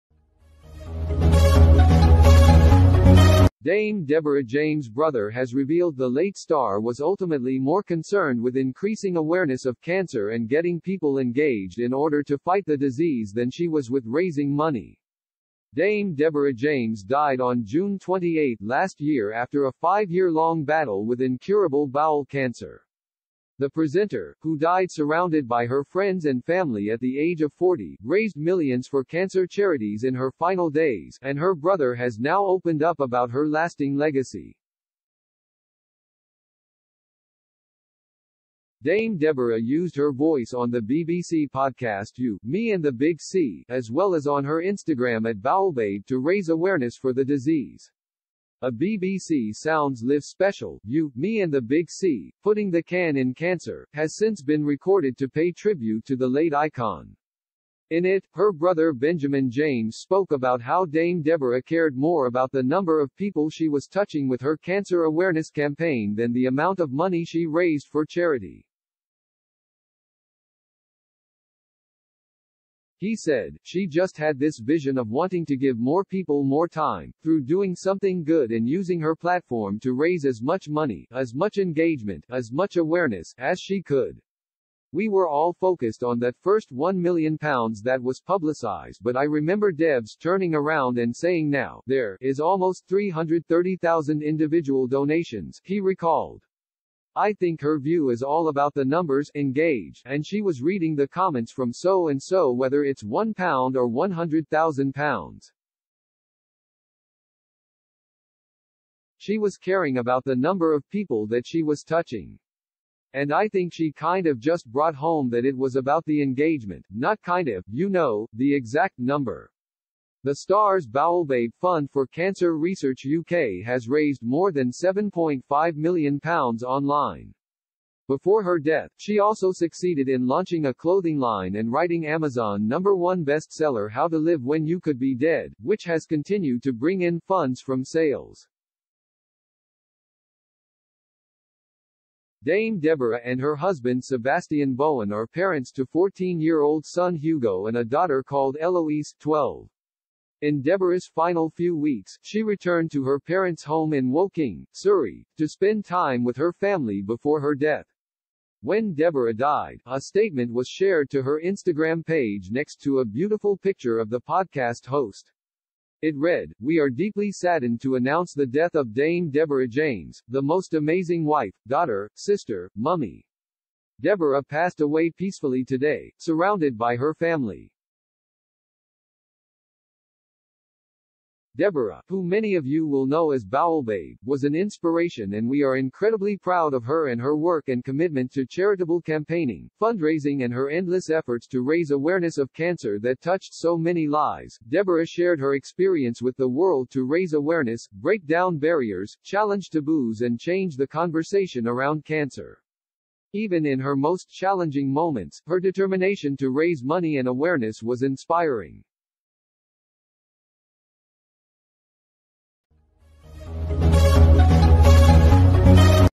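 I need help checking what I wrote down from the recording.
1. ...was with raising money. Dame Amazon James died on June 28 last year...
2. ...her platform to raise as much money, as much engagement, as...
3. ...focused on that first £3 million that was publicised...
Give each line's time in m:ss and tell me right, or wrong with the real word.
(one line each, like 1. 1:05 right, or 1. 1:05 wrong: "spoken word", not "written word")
1. 0:13 wrong: "Deborah", not "Amazon"
2. 1:18 right
3. 1:25 wrong: "1", not "3".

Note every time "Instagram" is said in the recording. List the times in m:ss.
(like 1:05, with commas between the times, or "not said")
0:44, 2:41.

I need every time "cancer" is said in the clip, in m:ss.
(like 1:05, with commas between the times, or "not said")
0:09, 0:22, 0:29, 0:53, 1:04, 2:02, 3:12, 3:22.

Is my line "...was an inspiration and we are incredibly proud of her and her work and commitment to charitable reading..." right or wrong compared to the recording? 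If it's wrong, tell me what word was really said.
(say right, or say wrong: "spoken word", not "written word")
wrong: "campaigning", not "reading".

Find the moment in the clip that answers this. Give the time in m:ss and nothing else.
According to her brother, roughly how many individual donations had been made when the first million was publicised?
1:32.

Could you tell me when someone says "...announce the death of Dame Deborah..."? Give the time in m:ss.
2:47.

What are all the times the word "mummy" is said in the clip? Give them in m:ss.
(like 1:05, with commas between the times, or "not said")
2:52.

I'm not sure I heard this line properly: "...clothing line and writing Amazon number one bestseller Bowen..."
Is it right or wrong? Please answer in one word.
wrong.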